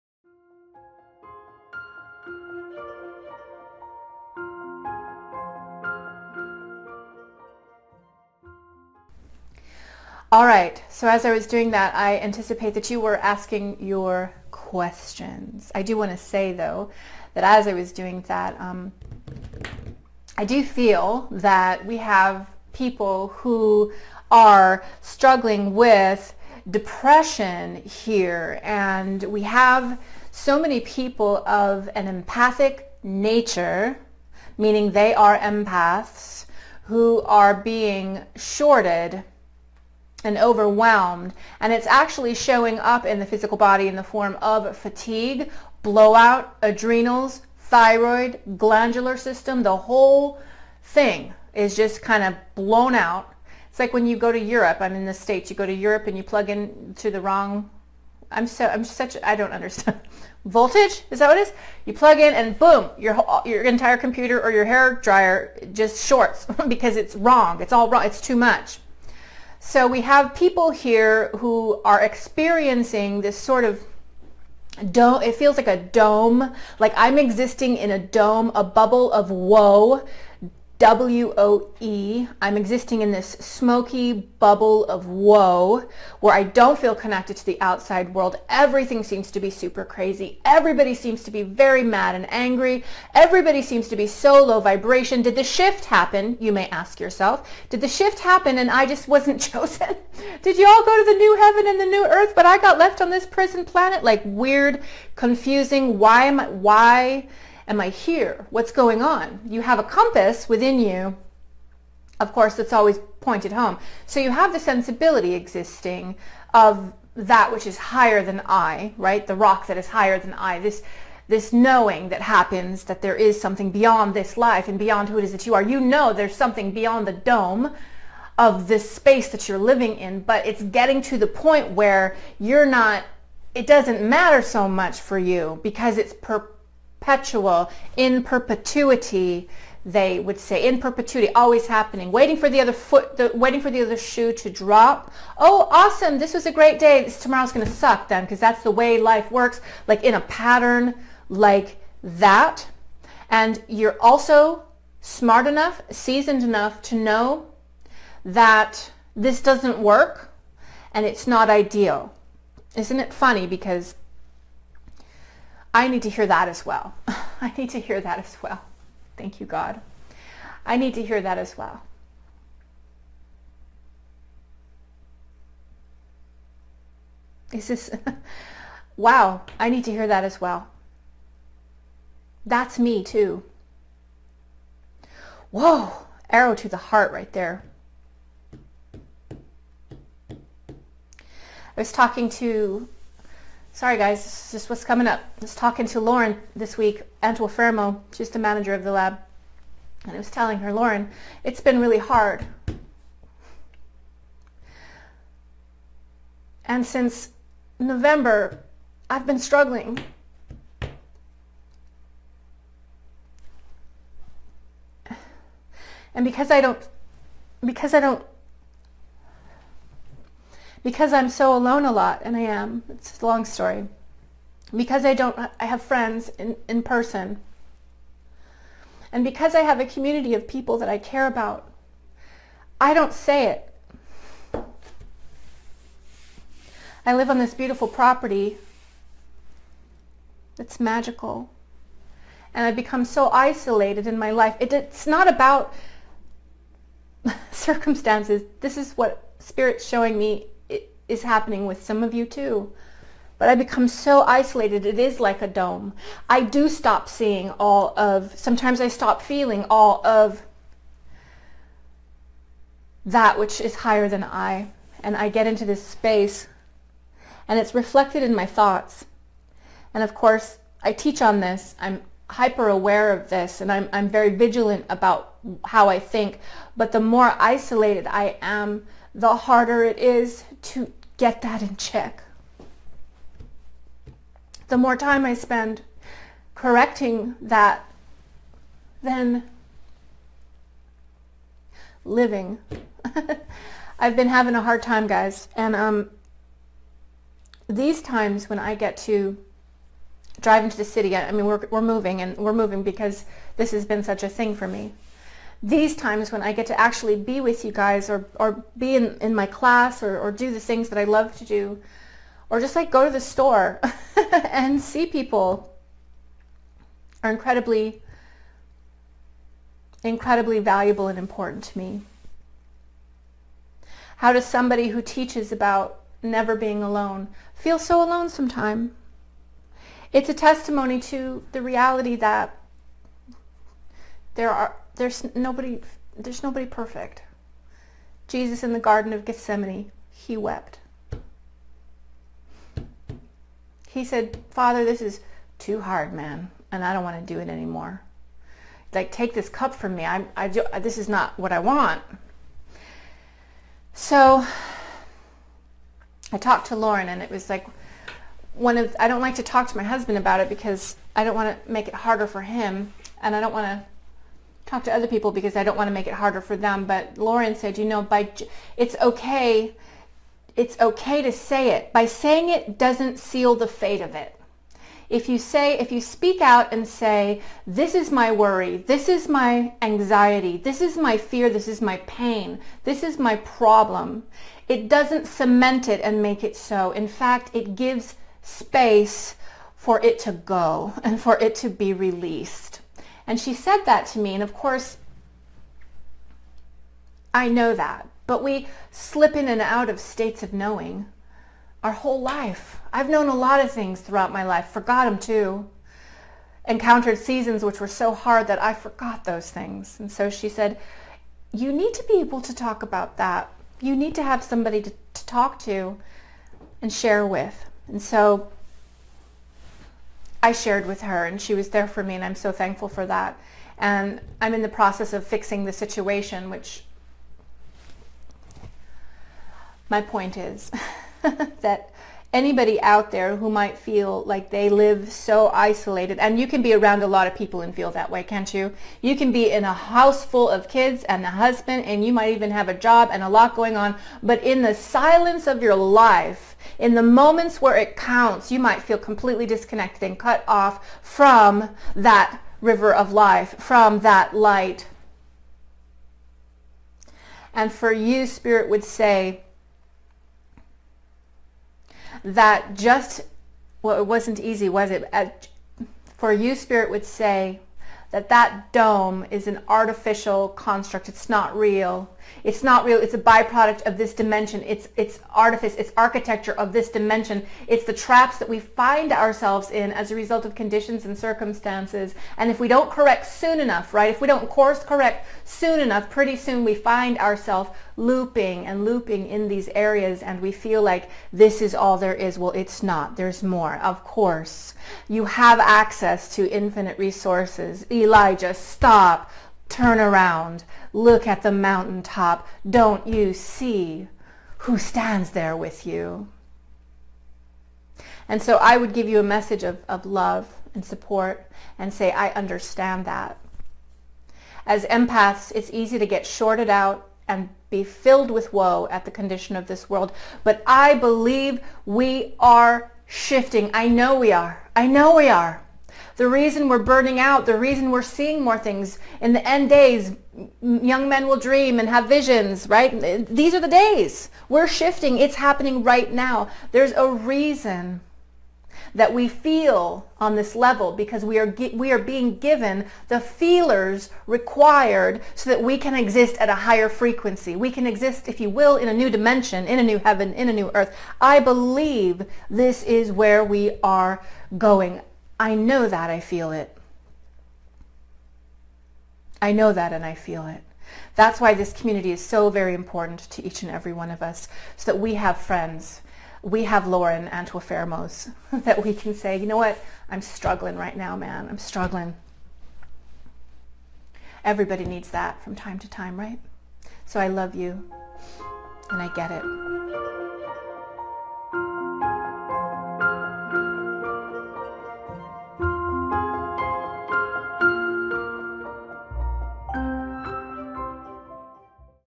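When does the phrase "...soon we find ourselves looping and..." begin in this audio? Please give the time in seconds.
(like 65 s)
486 s.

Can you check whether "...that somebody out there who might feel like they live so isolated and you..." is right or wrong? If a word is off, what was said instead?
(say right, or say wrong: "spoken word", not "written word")
wrong: "anybody", not "somebody".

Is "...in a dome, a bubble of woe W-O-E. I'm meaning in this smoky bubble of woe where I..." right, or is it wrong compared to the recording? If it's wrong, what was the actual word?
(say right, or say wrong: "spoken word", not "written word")
wrong: "existing", not "meaning".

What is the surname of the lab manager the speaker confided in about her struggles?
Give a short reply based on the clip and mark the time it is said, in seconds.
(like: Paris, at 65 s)
Antuofermo, at 197 s.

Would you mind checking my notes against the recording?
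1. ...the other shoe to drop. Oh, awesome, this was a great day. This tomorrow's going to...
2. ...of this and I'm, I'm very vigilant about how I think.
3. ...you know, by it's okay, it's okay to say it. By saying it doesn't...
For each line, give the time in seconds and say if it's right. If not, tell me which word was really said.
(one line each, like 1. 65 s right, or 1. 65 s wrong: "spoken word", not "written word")
1. 143 s right
2. 273 s right
3. 367 s right.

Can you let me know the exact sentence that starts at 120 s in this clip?
This this knowing that happens that there is something beyond this life and beyond who it is that you are.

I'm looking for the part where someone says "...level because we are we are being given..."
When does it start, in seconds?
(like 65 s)
540 s.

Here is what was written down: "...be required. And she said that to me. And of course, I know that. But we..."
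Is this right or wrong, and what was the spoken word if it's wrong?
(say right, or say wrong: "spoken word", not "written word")
wrong: "released", not "required".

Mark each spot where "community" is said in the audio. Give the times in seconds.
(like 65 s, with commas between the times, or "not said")
229 s, 561 s.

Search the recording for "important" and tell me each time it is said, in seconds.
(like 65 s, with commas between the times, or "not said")
321 s, 562 s.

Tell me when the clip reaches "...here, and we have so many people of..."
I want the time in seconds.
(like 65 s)
27 s.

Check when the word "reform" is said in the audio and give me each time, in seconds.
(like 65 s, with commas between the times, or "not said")
not said.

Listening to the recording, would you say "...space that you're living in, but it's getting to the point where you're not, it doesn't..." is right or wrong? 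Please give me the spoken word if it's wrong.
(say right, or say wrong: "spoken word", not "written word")
right.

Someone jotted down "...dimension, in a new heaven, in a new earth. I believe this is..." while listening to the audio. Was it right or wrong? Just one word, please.
right.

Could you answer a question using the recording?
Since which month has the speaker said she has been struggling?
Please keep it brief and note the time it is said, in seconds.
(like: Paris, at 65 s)
November, at 207 s.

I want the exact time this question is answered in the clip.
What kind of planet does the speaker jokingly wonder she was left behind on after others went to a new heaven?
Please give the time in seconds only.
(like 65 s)
103 s.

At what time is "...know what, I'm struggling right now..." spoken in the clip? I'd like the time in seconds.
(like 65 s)
569 s.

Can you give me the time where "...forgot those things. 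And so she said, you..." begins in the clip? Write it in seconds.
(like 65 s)
408 s.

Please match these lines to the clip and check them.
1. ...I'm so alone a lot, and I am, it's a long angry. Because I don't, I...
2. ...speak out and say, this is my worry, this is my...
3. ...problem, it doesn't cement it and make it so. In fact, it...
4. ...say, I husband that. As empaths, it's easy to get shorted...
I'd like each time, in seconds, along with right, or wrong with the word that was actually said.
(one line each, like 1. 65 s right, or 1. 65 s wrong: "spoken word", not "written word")
1. 221 s wrong: "story", not "angry"
2. 375 s right
3. 383 s right
4. 511 s wrong: "understand", not "husband".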